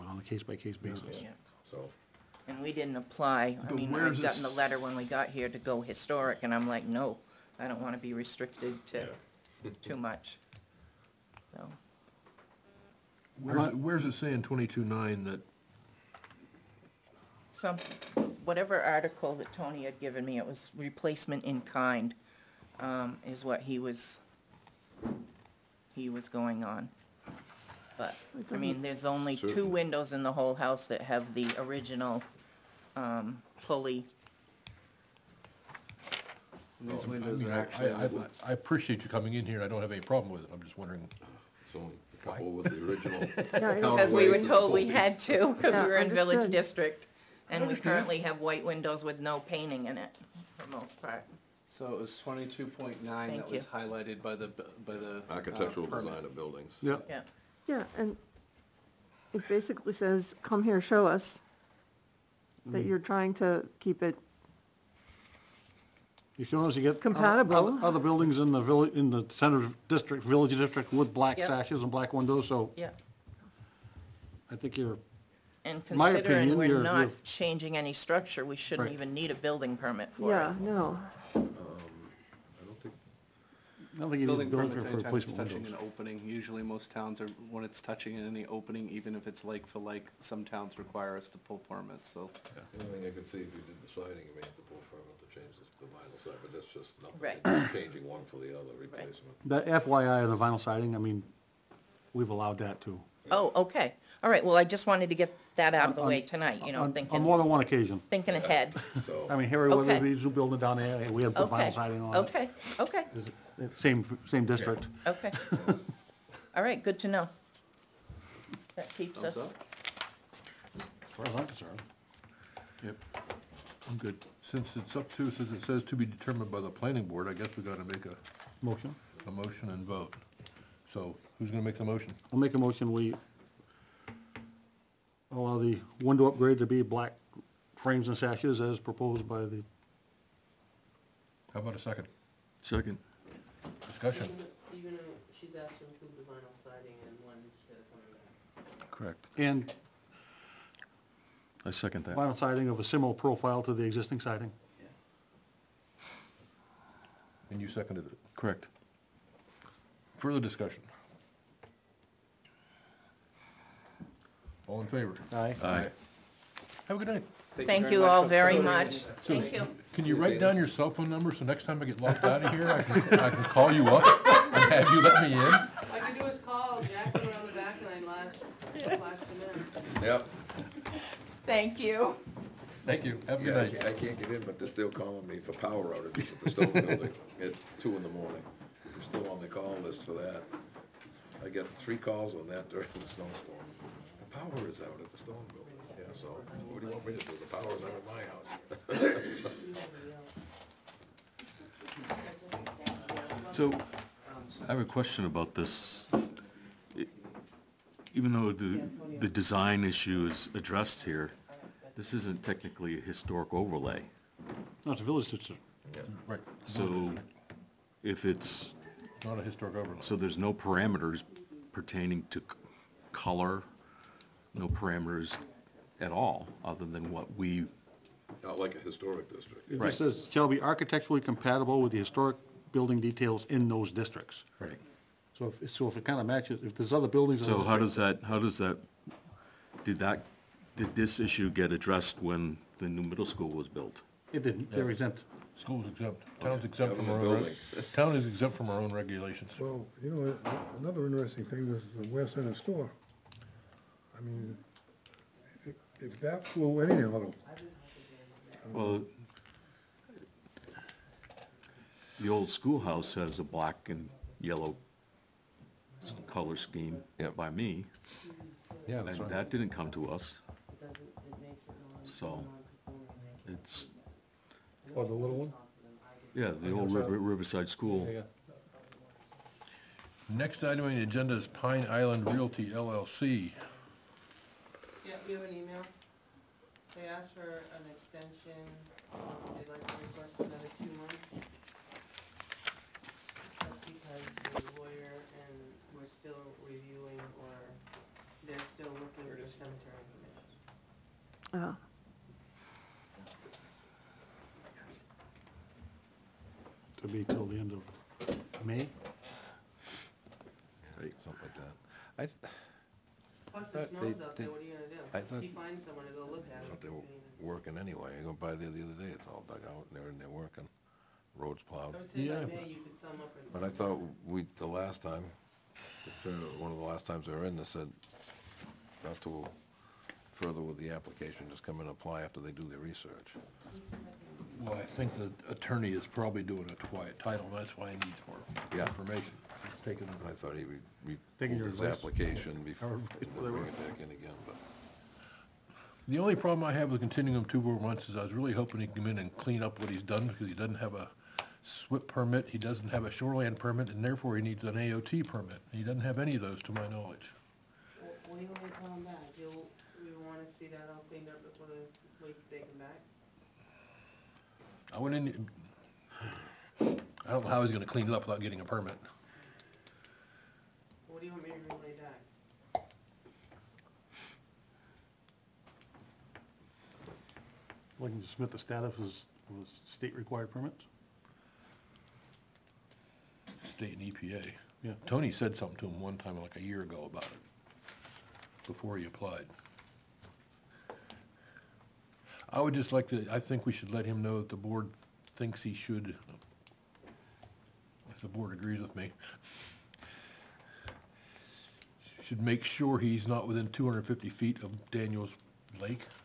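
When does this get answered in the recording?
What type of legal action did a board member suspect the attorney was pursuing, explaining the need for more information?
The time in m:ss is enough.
5:36.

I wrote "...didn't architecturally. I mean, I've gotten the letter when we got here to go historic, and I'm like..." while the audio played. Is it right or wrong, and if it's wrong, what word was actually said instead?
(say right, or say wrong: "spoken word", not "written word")
wrong: "apply", not "architecturally".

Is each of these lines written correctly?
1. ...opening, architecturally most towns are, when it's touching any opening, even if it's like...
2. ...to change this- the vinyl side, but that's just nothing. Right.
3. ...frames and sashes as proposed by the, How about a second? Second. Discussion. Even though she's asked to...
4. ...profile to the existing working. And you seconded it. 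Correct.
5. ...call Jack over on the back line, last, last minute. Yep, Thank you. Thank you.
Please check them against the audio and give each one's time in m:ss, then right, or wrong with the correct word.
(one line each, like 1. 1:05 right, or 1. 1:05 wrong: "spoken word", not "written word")
1. 1:25 wrong: "usually", not "architecturally"
2. 1:35 right
3. 2:17 right
4. 2:33 wrong: "siding", not "working"
5. 2:56 right.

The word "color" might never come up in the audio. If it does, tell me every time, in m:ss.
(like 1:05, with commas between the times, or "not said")
3:43, 4:26.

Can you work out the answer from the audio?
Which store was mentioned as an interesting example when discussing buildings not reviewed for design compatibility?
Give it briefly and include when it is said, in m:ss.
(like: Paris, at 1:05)
West Center store, at 4:12.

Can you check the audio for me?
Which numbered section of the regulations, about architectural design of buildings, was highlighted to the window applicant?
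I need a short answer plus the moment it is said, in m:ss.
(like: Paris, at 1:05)
22.9, at 0:52.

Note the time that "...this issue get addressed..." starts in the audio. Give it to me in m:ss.
4:00.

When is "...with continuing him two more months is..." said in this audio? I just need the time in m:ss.
5:46.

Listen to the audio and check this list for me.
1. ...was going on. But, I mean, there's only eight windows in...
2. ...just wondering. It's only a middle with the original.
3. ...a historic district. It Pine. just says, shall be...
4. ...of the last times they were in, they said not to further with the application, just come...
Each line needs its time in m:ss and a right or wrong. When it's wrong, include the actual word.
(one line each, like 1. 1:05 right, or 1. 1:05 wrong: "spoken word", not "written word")
1. 0:26 wrong: "two", not "eight"
2. 0:40 wrong: "couple", not "middle"
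3. 3:48 wrong: "Right", not "Pine"
4. 5:26 right.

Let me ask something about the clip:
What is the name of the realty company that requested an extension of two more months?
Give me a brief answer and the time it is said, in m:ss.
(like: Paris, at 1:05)
Pine Island Realty LLC, at 4:41.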